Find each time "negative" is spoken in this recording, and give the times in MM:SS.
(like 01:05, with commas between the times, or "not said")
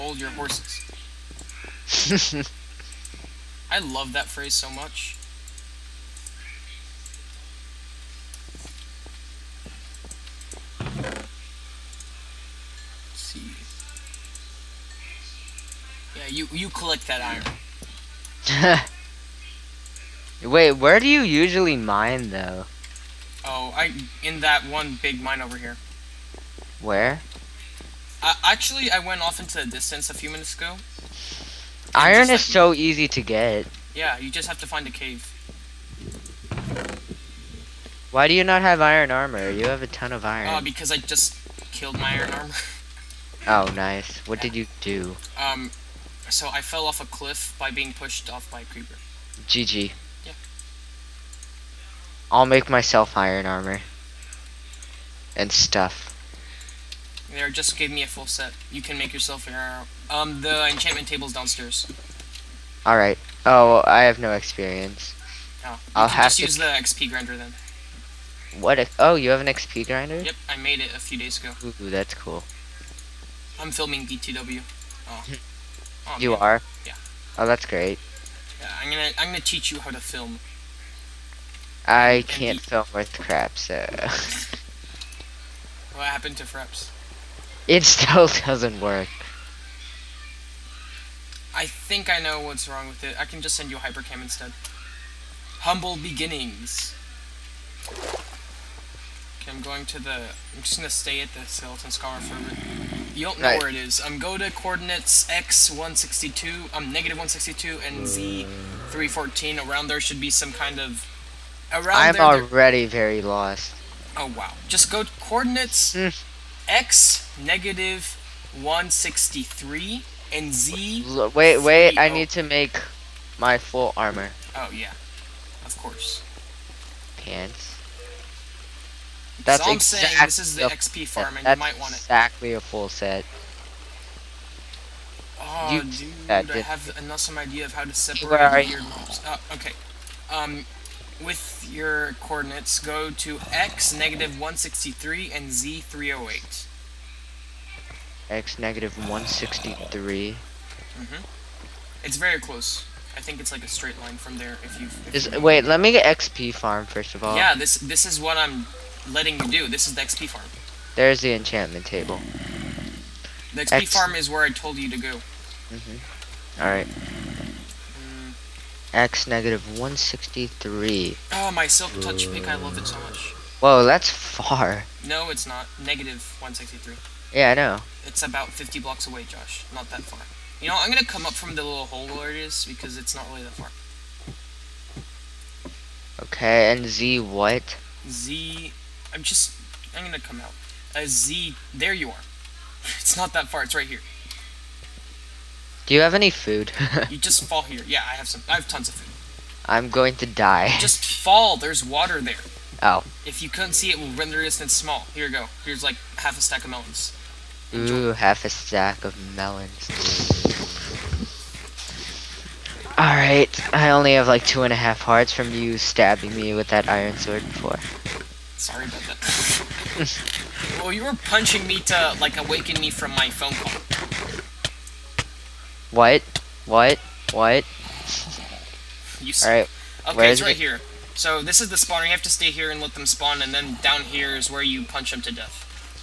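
01:46, 01:57, 02:23, 02:28, 02:49, 02:55.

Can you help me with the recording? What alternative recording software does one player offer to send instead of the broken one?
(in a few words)
Hypercam.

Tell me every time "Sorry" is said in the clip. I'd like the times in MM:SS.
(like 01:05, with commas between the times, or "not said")
03:38.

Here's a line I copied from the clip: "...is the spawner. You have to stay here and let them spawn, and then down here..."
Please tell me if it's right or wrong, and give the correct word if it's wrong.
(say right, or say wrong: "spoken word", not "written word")
right.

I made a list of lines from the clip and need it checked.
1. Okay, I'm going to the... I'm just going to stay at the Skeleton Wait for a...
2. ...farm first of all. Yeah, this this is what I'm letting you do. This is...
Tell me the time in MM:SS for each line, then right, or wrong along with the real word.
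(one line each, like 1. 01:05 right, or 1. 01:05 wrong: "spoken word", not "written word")
1. 01:37 wrong: "Scar", not "Wait"
2. 02:36 right.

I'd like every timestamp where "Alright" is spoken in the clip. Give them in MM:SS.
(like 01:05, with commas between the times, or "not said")
01:02, 03:32.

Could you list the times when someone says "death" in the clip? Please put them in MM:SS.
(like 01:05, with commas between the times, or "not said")
03:55.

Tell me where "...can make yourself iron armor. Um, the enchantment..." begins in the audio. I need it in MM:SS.
00:58.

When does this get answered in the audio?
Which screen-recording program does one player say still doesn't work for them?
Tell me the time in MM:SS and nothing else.
01:26.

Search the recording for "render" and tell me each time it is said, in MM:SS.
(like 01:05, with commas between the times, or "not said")
03:24.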